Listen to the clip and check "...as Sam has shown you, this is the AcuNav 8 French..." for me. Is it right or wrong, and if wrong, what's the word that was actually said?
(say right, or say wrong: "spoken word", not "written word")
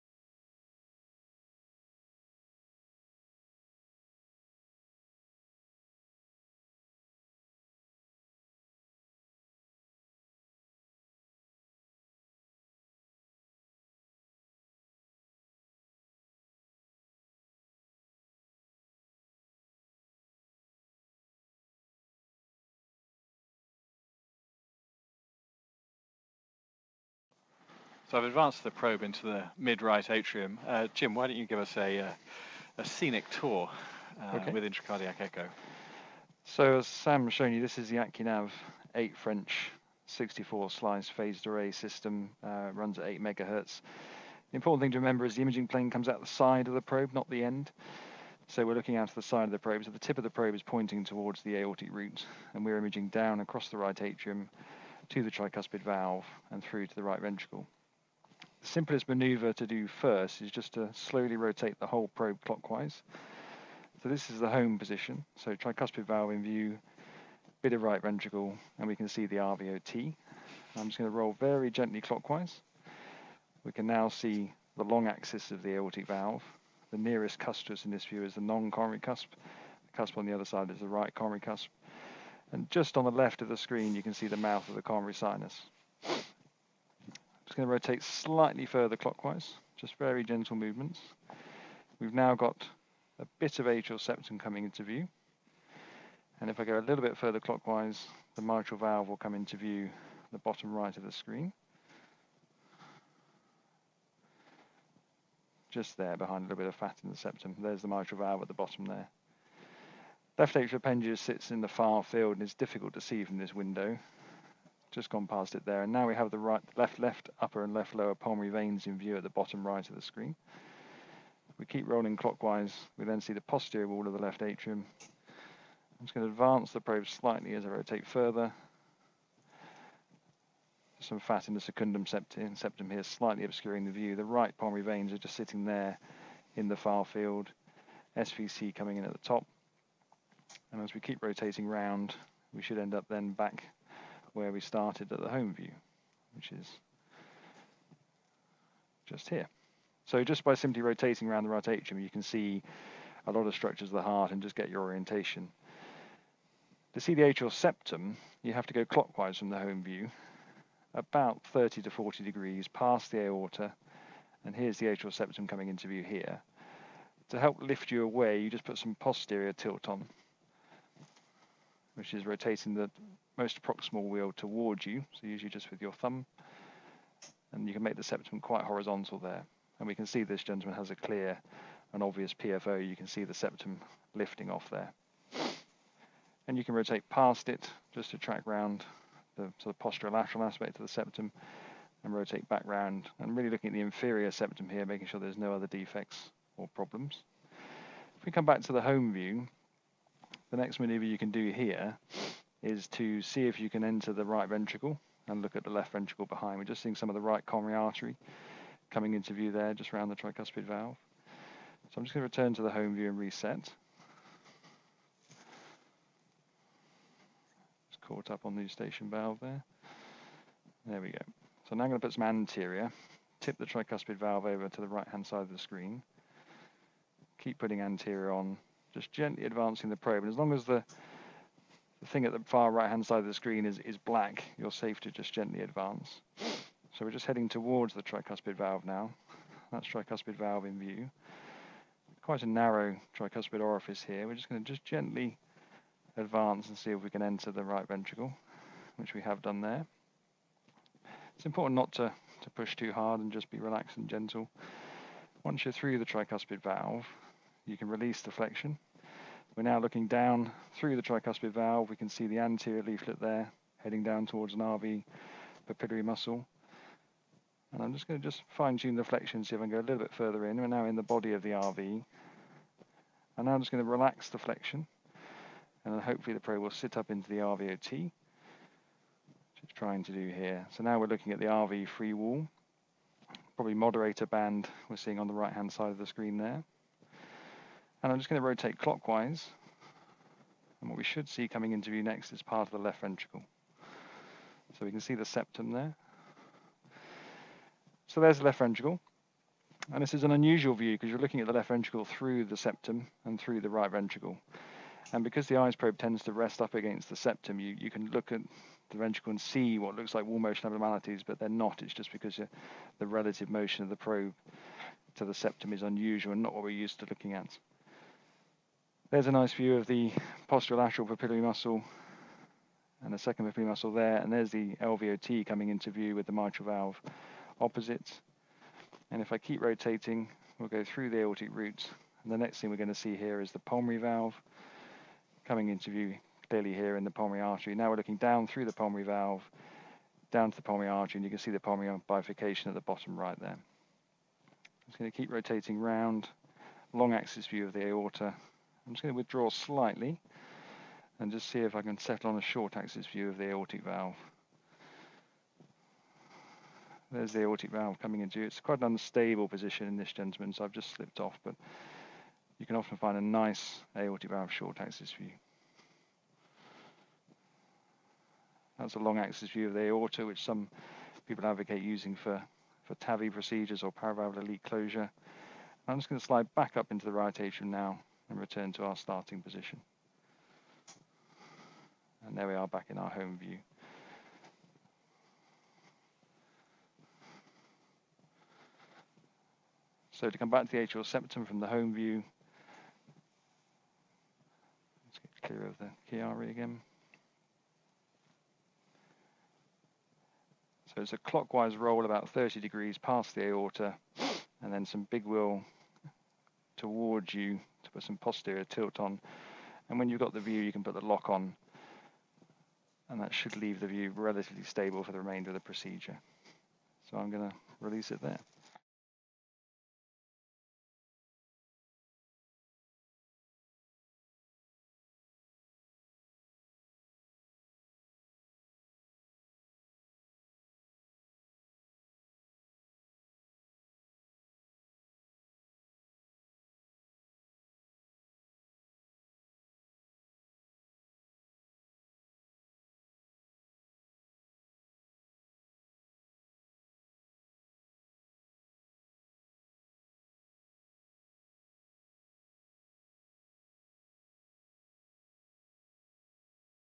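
right.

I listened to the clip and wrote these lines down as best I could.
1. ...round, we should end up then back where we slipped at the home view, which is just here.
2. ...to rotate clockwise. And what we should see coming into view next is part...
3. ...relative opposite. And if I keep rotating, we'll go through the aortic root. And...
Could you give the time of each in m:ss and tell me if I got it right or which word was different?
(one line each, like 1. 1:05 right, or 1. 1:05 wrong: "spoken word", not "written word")
1. 2:21 wrong: "started", not "slipped"
2. 4:48 right
3. 5:26 wrong: "valve", not "relative".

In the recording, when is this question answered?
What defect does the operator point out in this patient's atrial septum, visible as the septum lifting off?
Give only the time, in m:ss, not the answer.
3:02.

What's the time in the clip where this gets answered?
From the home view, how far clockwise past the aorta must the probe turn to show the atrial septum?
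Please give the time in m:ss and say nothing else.
2:41.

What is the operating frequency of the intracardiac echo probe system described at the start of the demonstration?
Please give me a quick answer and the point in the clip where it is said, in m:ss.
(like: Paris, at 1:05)
8 megahertz, at 0:43.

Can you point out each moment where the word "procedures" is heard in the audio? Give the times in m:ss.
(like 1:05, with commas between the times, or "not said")
6:13, 6:55.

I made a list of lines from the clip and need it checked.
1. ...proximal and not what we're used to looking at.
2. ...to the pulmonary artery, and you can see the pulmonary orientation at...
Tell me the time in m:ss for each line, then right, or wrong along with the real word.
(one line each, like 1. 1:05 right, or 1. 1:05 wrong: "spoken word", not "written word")
1. 5:15 wrong: "unusual", not "proximal"
2. 5:40 wrong: "bifurcation", not "orientation".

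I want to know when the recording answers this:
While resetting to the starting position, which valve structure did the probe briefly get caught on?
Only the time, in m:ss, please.
3:38.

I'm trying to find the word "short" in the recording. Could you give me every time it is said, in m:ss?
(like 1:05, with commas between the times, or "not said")
5:52, 6:04.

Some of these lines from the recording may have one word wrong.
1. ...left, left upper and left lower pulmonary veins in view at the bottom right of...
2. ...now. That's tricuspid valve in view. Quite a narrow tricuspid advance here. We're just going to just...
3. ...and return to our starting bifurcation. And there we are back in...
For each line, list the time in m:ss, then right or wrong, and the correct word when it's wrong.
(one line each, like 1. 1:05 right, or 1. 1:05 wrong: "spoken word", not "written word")
1. 1:56 right
2. 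3:58 wrong: "orifice", not "advance"
3. 6:18 wrong: "position", not "bifurcation".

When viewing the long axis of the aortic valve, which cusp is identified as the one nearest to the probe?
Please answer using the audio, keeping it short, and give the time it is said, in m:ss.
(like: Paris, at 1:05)
Non-coronary cusp, at 1:18.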